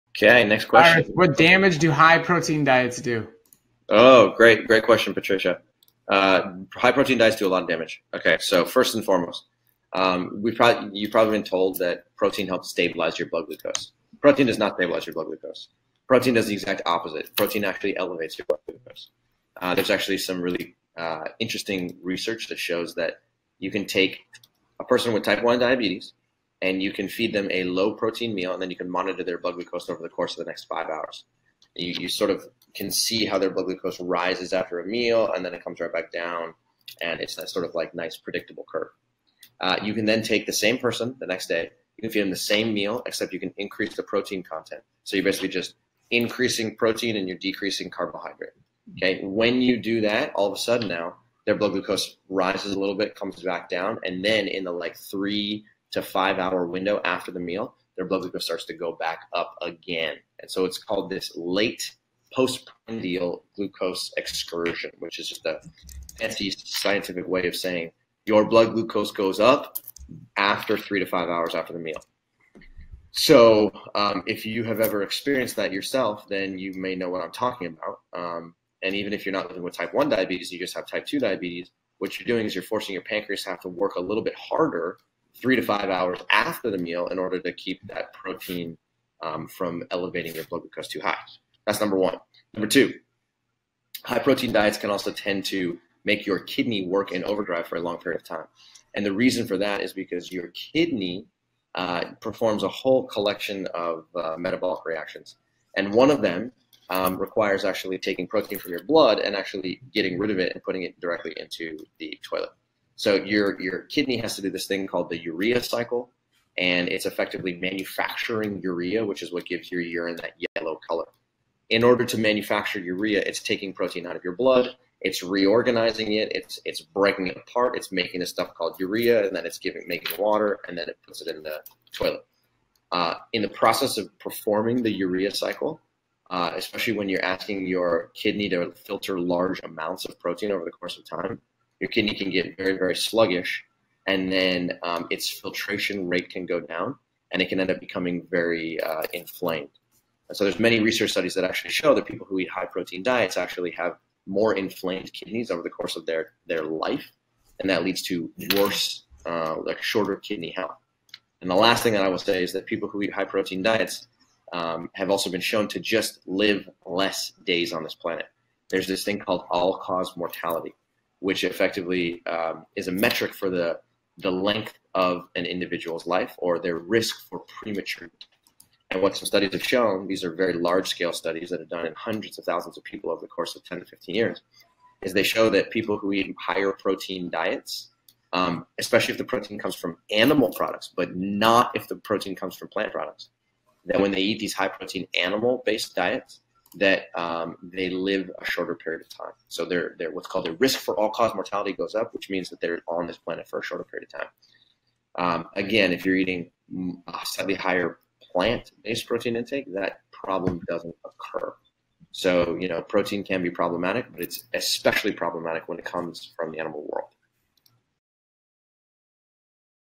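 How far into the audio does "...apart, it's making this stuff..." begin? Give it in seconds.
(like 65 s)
127 s.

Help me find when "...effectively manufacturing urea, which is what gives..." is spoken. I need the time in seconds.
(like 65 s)
117 s.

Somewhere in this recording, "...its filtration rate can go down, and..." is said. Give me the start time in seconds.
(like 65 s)
145 s.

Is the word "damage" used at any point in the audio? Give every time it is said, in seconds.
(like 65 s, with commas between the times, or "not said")
1 s, 7 s.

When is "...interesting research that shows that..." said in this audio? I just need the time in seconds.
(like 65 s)
21 s.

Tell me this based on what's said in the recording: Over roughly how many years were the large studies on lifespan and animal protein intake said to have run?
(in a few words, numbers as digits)
10 to 15 years.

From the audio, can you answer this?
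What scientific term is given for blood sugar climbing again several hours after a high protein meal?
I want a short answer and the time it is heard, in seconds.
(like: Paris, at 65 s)
late postprandial glucose excursion, at 61 s.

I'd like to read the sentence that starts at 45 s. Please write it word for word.
So you're basically just increasing protein and you're decreasing carbohydrate.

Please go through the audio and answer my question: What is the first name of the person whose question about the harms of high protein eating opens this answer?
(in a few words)
Patricia.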